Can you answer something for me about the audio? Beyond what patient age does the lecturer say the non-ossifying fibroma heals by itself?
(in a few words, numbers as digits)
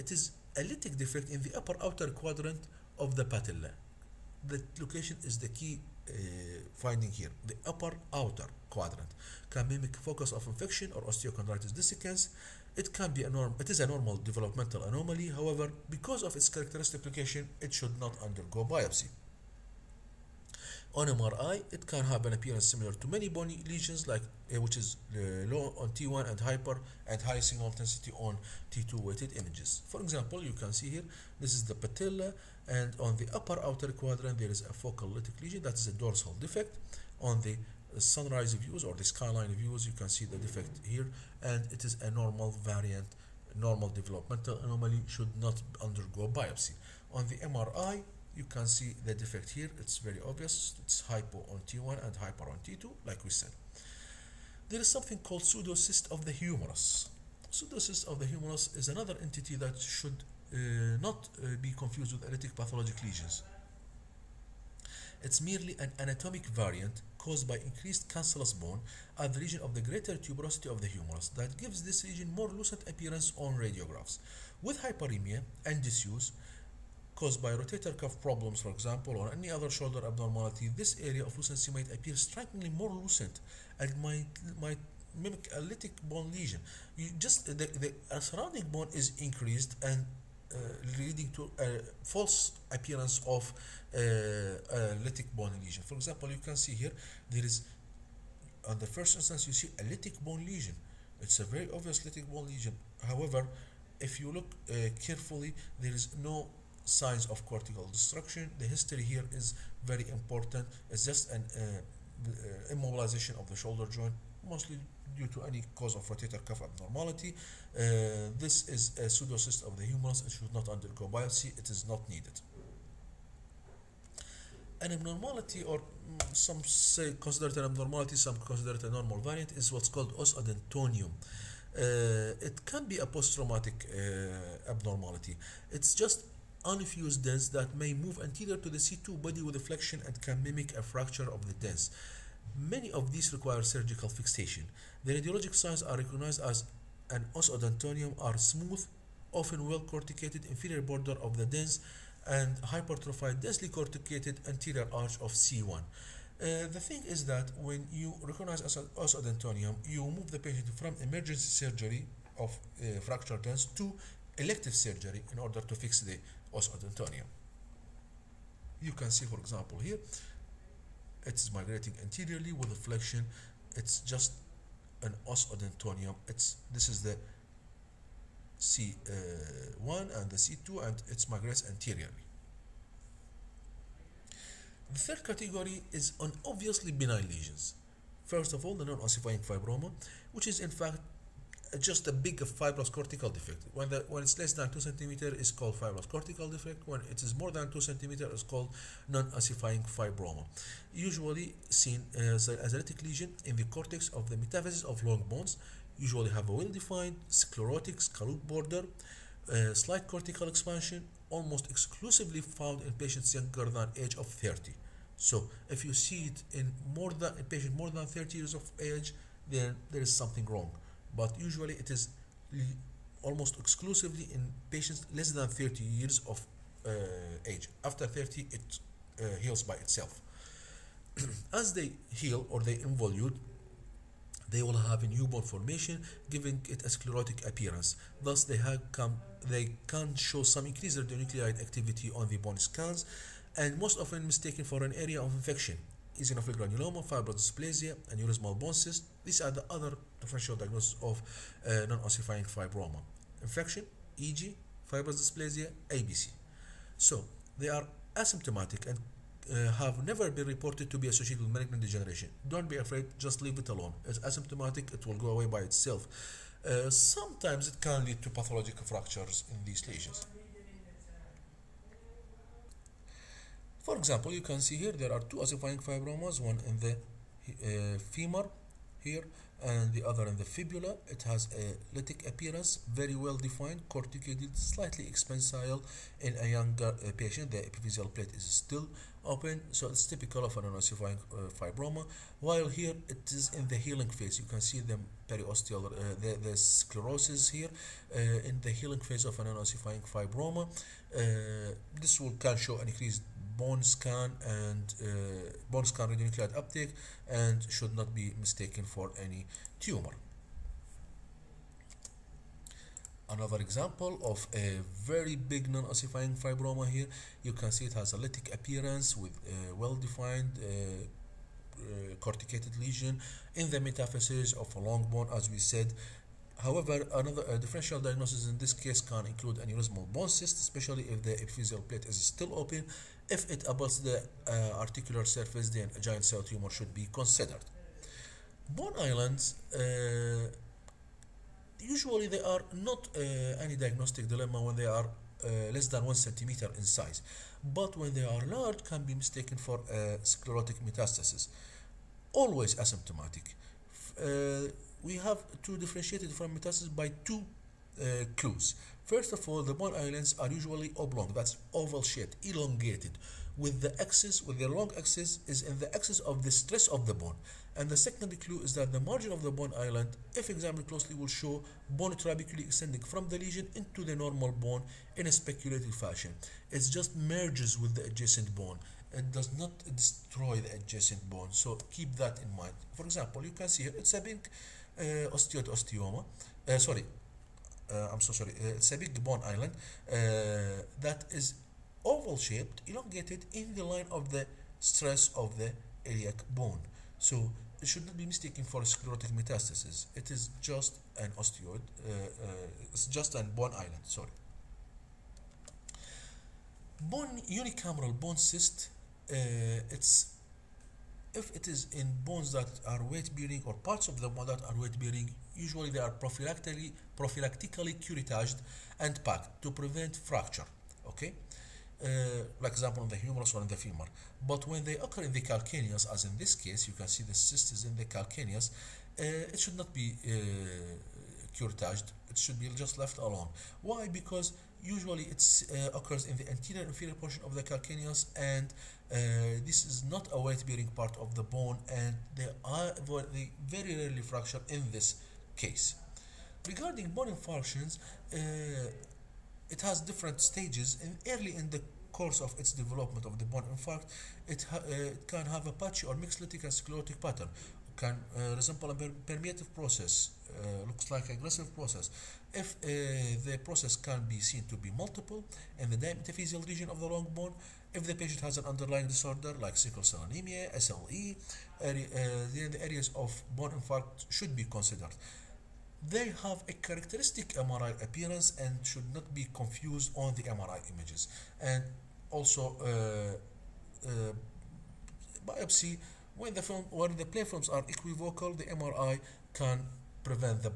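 30.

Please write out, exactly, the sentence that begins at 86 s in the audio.
You just the, the surrounding bone is increased and uh, leading to a false appearance of uh, lytic bone lesion.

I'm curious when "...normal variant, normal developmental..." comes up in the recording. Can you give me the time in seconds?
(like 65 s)
42 s.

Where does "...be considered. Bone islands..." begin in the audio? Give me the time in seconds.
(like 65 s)
336 s.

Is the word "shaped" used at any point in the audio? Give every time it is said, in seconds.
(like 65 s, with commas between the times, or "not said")
362 s, 392 s.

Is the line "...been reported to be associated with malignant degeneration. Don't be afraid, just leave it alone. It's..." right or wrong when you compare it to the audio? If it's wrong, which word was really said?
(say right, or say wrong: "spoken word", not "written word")
right.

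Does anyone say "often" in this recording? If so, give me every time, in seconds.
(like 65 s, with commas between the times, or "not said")
149 s, 243 s.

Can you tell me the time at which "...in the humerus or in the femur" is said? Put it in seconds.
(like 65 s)
423 s.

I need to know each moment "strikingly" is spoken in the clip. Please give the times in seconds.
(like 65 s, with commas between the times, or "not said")
82 s.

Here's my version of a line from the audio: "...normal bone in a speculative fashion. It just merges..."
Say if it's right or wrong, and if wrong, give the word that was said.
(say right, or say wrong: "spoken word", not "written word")
right.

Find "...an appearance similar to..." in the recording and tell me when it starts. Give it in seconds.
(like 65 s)
22 s.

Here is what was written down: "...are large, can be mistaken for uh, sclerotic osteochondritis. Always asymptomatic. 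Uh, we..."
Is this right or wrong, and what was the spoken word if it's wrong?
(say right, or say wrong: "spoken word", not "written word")
wrong: "metastasis", not "osteochondritis".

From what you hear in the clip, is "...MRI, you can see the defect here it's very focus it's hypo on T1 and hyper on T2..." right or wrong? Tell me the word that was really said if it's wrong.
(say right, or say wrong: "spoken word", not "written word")
wrong: "obvious", not "focus".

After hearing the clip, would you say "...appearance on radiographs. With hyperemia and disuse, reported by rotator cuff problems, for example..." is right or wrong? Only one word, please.
wrong.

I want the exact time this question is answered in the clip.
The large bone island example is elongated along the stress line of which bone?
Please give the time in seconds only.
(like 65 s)
396 s.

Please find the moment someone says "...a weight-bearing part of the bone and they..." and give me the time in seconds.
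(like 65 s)
440 s.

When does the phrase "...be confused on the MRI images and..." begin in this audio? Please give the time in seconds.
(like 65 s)
479 s.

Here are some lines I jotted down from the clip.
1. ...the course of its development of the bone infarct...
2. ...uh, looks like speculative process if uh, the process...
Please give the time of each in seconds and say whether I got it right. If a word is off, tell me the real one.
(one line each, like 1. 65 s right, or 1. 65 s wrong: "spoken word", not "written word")
1. 451 s right
2. 460 s wrong: "aggressive", not "speculative".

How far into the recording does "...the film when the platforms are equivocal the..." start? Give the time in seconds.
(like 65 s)
486 s.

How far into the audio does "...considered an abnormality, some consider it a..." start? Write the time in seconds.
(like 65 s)
127 s.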